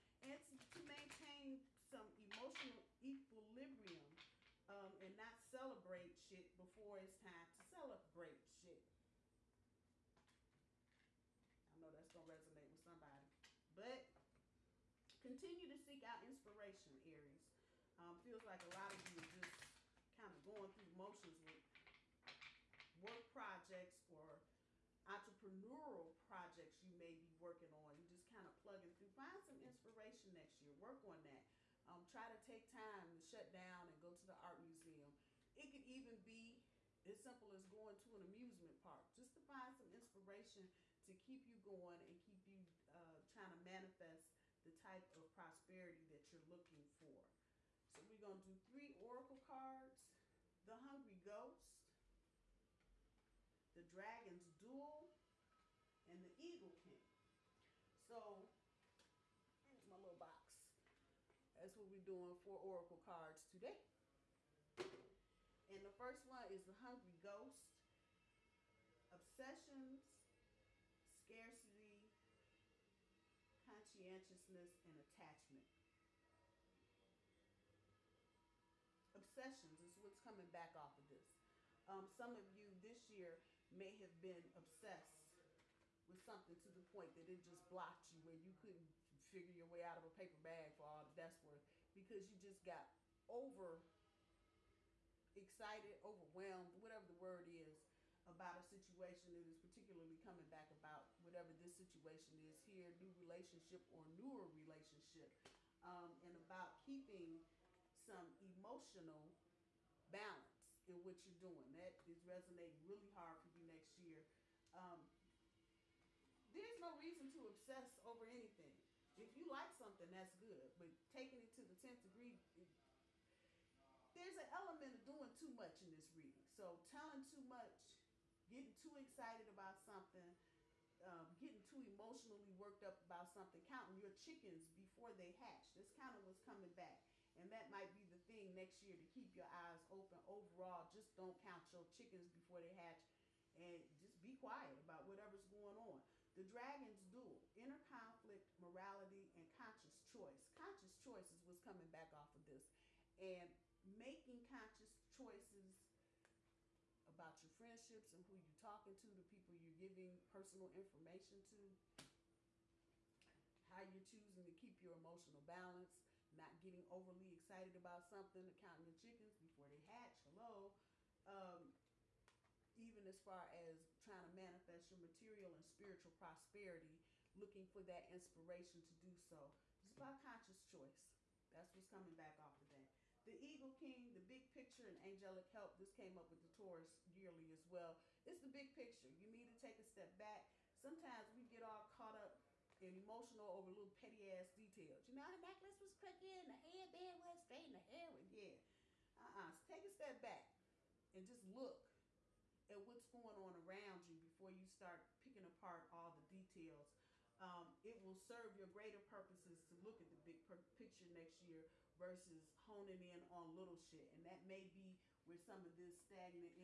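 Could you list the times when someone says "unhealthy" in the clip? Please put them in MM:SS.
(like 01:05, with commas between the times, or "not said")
not said.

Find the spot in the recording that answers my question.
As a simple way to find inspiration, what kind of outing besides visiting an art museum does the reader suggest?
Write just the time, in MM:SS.
00:38.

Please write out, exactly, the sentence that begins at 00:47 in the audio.
So we're going to do three oracle cards.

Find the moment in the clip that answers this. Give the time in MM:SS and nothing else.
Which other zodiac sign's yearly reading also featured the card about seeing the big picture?
03:06.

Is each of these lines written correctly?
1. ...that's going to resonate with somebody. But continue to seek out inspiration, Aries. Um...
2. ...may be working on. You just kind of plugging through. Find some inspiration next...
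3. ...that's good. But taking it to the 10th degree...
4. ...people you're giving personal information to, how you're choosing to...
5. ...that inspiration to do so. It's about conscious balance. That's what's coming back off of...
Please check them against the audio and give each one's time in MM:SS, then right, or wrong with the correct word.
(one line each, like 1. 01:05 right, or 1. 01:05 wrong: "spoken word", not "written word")
1. 00:11 right
2. 00:26 right
3. 02:00 right
4. 02:39 right
5. 02:57 wrong: "choice", not "balance".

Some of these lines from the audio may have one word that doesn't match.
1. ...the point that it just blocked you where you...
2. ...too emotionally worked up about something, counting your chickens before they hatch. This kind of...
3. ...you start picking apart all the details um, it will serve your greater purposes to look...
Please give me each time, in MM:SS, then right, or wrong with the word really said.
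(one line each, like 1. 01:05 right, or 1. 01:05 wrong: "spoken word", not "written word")
1. 01:26 right
2. 02:11 right
3. 03:24 right.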